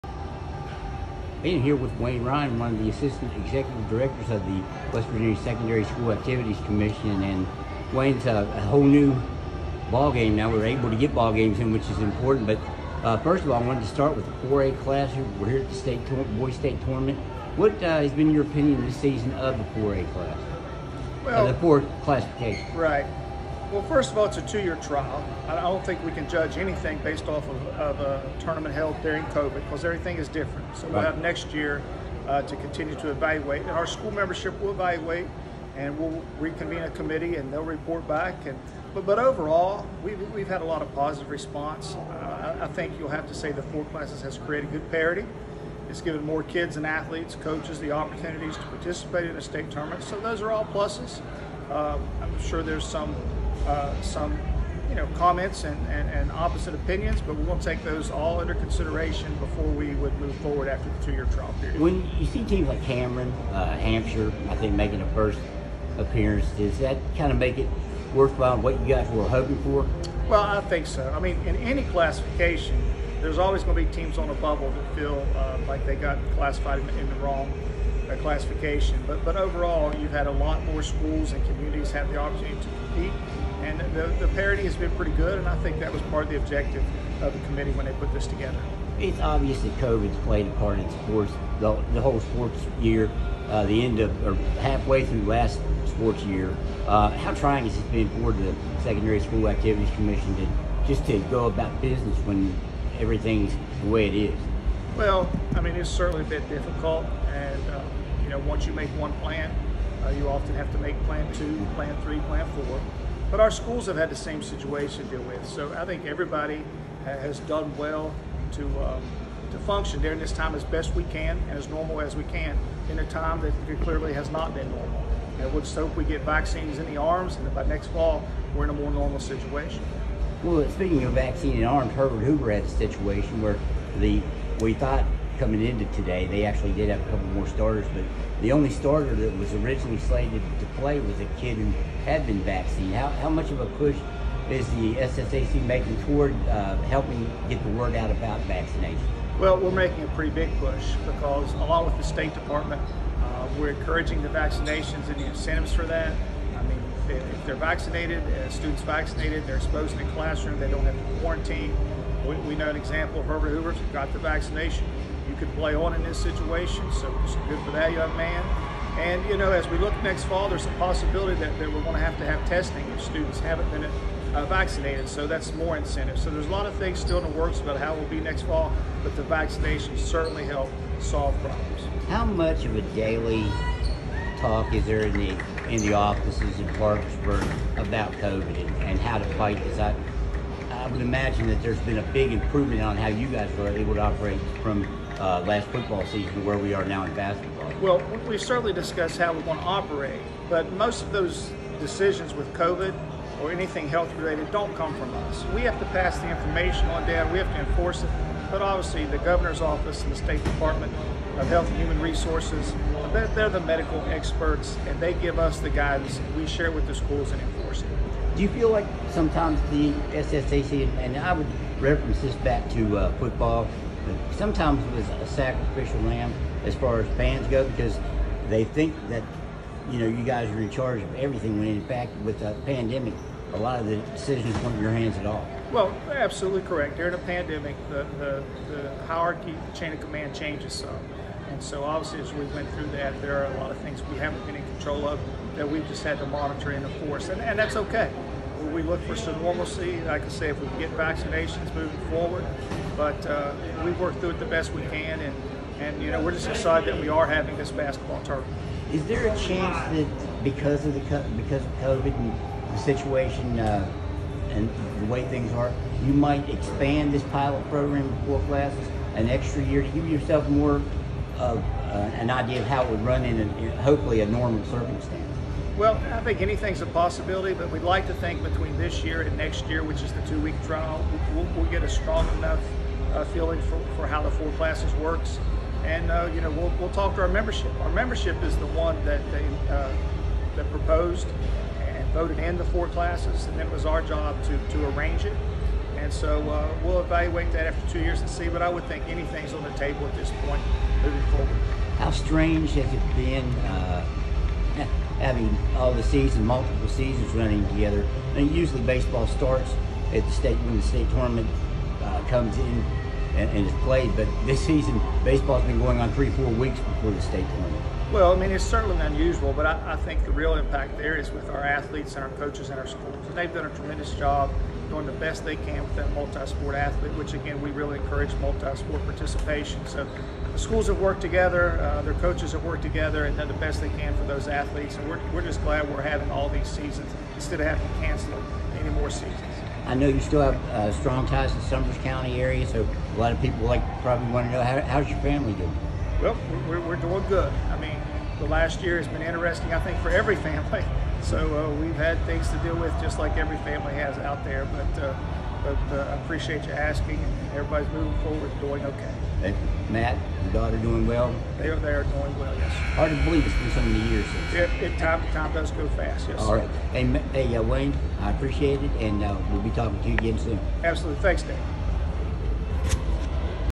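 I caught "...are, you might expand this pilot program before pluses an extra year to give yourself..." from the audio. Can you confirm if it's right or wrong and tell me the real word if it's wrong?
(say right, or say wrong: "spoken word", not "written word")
wrong: "classes", not "pluses".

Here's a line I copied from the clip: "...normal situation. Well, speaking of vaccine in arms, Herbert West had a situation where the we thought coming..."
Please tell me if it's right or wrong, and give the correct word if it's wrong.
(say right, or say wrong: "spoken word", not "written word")
wrong: "Hoover", not "West".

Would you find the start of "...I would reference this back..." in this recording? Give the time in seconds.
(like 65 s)
221 s.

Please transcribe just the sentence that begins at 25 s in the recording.
I don't think we can judge anything based off of, of a tournament held during COVID because everything is different.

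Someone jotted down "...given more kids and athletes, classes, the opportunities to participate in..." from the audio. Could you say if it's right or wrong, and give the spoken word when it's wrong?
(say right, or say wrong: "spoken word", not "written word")
wrong: "coaches", not "classes".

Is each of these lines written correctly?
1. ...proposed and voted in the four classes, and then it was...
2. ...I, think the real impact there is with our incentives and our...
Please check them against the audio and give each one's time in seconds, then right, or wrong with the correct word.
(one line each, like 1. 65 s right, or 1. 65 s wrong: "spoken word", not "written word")
1. 290 s right
2. 319 s wrong: "athletes", not "incentives".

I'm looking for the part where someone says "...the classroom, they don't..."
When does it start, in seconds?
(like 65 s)
160 s.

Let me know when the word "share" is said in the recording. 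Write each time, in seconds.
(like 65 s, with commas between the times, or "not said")
216 s.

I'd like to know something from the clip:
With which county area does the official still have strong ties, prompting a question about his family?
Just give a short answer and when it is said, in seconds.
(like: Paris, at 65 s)
Summers County, at 341 s.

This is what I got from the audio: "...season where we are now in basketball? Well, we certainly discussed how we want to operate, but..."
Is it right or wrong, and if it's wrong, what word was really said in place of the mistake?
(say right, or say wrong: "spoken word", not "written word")
right.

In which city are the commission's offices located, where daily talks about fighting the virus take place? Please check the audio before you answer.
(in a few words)
Parkersburg.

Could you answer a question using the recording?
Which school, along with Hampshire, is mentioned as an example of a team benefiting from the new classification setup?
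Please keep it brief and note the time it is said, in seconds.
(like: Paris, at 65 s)
Cameron, at 62 s.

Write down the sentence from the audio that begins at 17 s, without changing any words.
What uh, has been your opinion this season of the 4A class?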